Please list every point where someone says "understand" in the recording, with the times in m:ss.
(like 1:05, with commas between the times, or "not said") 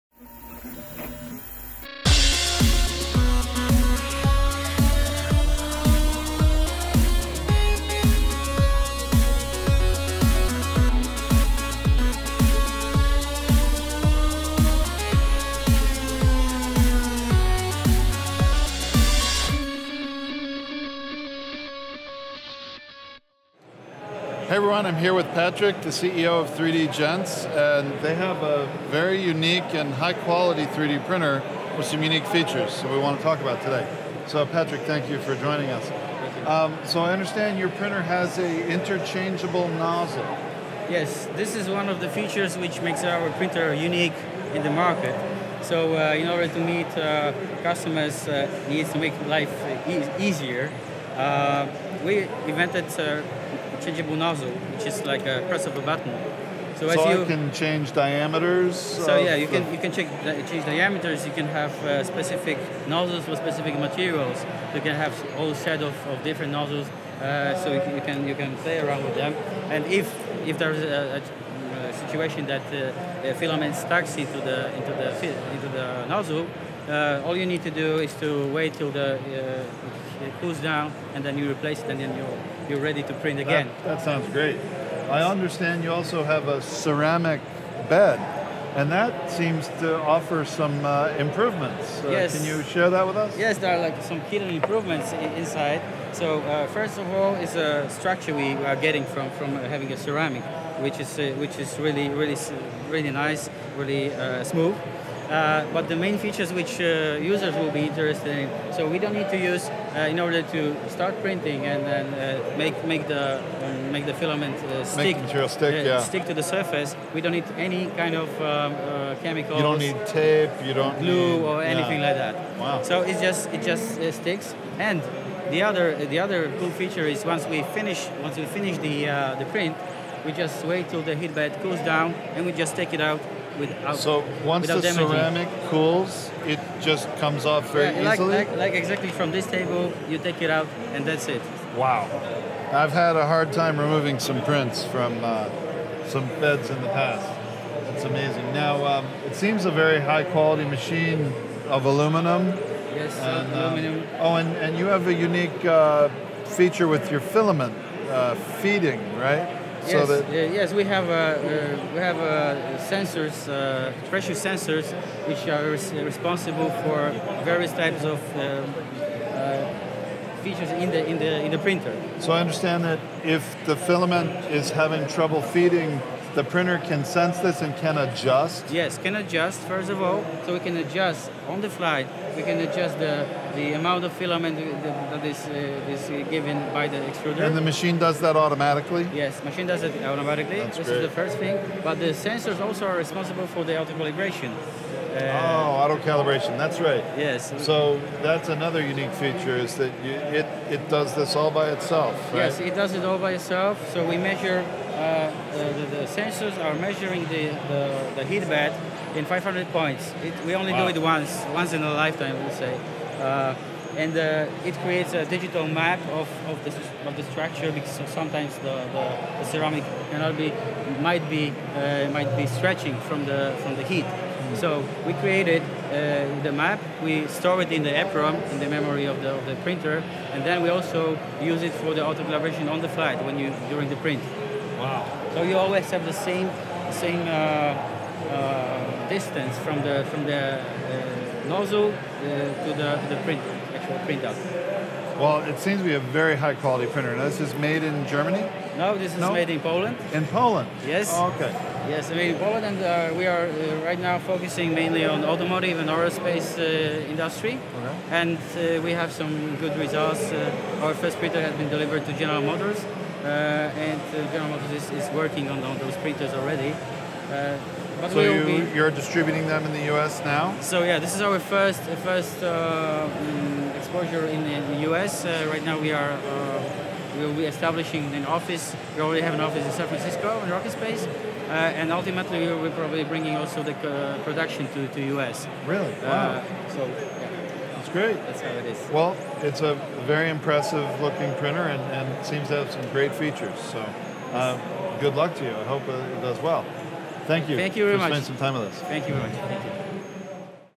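0:37, 1:25, 2:52.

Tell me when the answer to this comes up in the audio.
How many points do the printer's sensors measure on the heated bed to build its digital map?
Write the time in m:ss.
3:29.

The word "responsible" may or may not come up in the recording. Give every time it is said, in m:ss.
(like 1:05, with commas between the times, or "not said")
2:45, 3:12.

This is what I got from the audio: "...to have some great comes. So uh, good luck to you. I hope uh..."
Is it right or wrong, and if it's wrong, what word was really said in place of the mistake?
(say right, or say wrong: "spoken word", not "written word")
wrong: "features", not "comes".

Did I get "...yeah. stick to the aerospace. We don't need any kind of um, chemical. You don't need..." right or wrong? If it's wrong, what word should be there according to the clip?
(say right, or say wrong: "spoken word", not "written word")
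wrong: "surface", not "aerospace".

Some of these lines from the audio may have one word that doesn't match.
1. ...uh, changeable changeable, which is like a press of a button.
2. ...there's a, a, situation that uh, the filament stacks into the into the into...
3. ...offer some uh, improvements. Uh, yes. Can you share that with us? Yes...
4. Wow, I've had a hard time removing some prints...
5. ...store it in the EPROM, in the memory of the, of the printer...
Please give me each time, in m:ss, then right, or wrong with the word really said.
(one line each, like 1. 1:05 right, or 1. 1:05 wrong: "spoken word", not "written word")
1. 0:52 wrong: "nozzle", not "changeable"
2. 1:10 right
3. 1:29 right
4. 2:21 right
5. 3:47 right.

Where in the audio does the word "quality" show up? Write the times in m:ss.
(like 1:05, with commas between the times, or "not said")
0:30, 2:30, 4:06.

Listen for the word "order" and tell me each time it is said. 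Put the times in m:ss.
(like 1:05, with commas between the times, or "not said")
0:46, 1:50.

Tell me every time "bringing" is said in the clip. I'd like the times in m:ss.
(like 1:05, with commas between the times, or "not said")
4:43.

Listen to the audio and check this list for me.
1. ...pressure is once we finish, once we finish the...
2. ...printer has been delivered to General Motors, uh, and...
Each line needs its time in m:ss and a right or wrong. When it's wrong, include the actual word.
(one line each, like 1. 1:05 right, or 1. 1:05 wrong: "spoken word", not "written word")
1. 2:06 wrong: "feature", not "pressure"
2. 4:21 right.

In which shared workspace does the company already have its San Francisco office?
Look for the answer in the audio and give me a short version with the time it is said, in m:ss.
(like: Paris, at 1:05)
RocketSpace, at 4:40.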